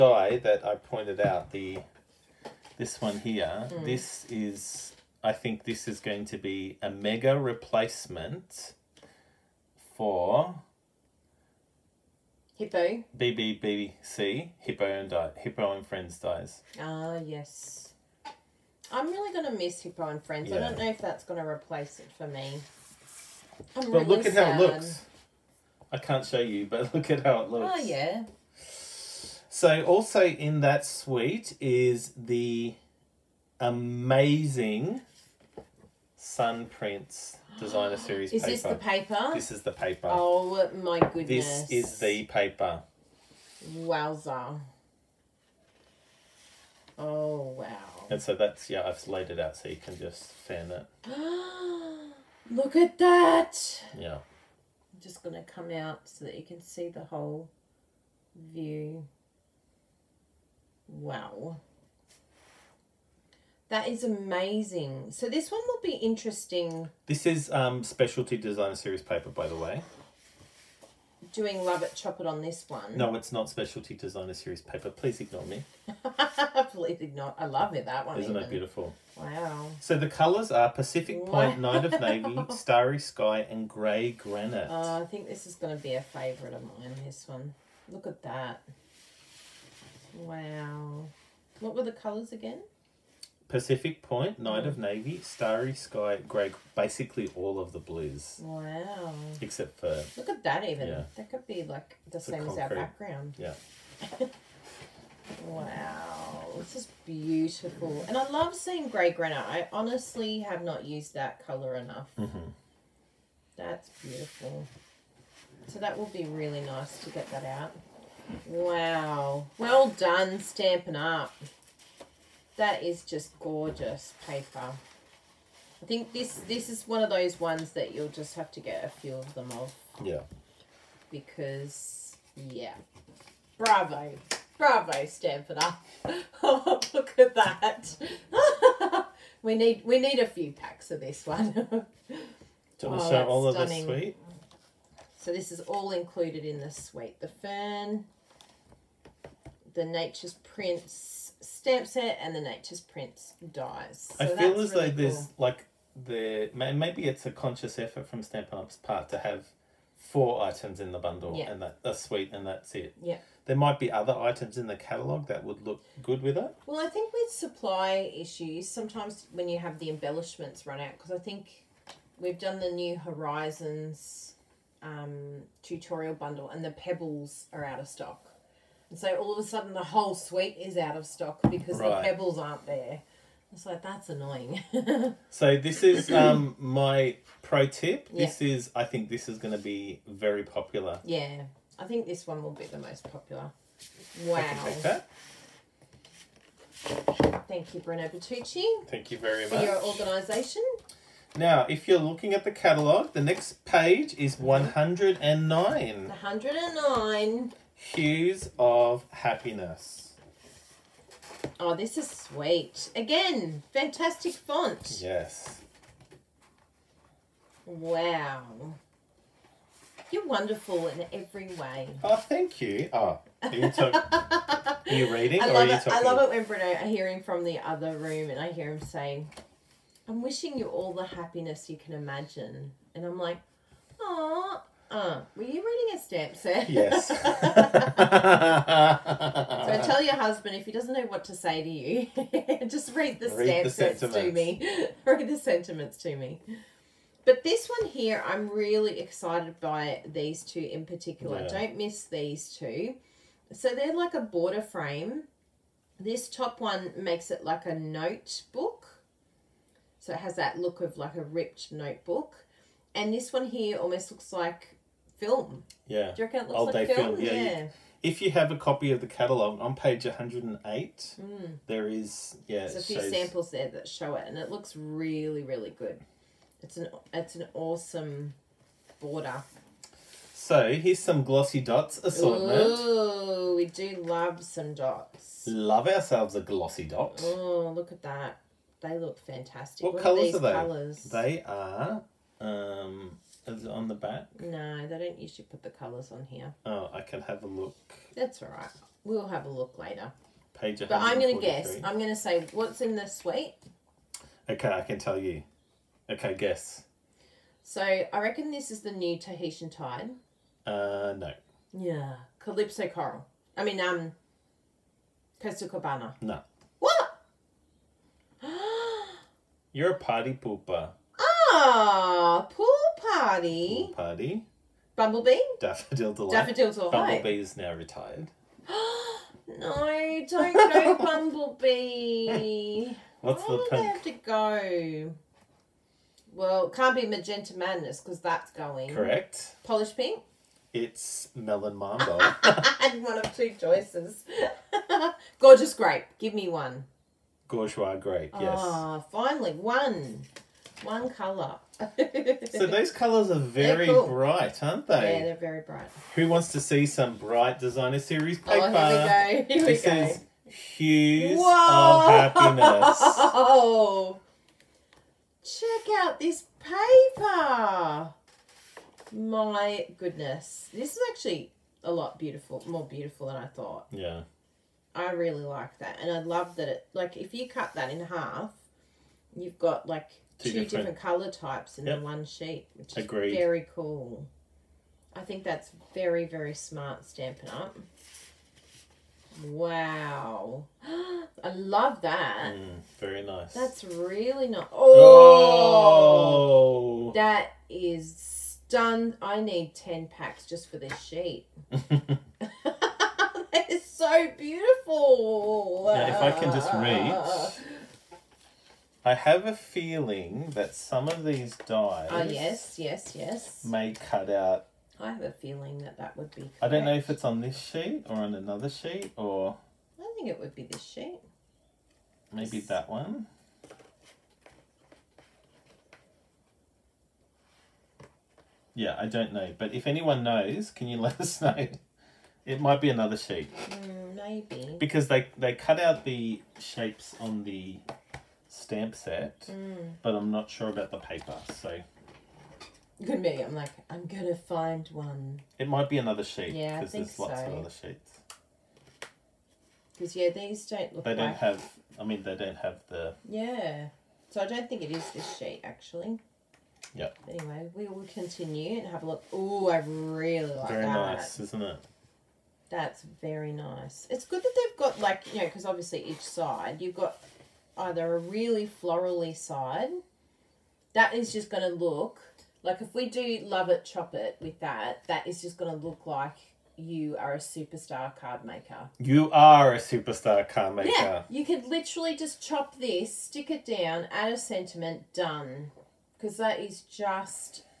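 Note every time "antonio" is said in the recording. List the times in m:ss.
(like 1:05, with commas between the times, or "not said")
not said.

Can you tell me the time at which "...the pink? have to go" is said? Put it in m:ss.
5:33.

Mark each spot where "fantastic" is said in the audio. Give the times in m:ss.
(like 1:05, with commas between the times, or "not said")
3:33, 4:49.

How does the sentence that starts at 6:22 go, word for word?
one sheet, which is very cool.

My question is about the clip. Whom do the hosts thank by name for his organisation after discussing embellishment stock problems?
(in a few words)
Bruno Bertucci.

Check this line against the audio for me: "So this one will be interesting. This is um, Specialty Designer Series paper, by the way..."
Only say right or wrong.
right.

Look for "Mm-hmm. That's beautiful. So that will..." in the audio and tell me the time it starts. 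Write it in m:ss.
1:52.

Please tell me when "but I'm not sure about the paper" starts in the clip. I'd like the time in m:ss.
7:20.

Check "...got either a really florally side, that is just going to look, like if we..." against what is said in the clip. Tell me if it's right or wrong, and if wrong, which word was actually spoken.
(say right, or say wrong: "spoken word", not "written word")
right.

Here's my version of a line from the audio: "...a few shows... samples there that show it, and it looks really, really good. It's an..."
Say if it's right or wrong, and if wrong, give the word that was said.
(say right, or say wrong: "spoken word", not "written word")
right.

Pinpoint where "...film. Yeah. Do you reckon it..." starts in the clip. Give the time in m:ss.
4:25.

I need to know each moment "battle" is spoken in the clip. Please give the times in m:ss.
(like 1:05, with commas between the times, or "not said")
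not said.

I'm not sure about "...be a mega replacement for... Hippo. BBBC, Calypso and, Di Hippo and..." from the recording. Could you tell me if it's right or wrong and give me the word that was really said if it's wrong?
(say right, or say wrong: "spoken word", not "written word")
wrong: "Hippo", not "Calypso".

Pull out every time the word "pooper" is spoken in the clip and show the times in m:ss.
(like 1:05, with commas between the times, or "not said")
5:20.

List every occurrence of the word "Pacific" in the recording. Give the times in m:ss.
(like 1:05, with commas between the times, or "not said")
1:20, 1:33.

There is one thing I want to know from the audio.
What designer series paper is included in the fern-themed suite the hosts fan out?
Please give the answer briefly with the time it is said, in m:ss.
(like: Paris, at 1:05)
Sun Prints, at 0:36.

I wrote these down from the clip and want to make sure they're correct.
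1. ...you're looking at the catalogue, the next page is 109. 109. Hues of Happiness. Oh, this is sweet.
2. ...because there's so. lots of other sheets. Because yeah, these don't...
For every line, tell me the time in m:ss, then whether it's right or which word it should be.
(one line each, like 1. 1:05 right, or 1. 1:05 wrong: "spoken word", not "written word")
1. 3:21 right
2. 7:26 right.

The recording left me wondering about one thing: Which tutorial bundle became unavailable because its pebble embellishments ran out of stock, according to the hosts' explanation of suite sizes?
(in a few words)
New Horizons.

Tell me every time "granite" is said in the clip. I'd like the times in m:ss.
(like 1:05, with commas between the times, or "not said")
1:24, 1:49.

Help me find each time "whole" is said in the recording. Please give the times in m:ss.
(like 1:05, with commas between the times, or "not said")
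0:57, 2:59.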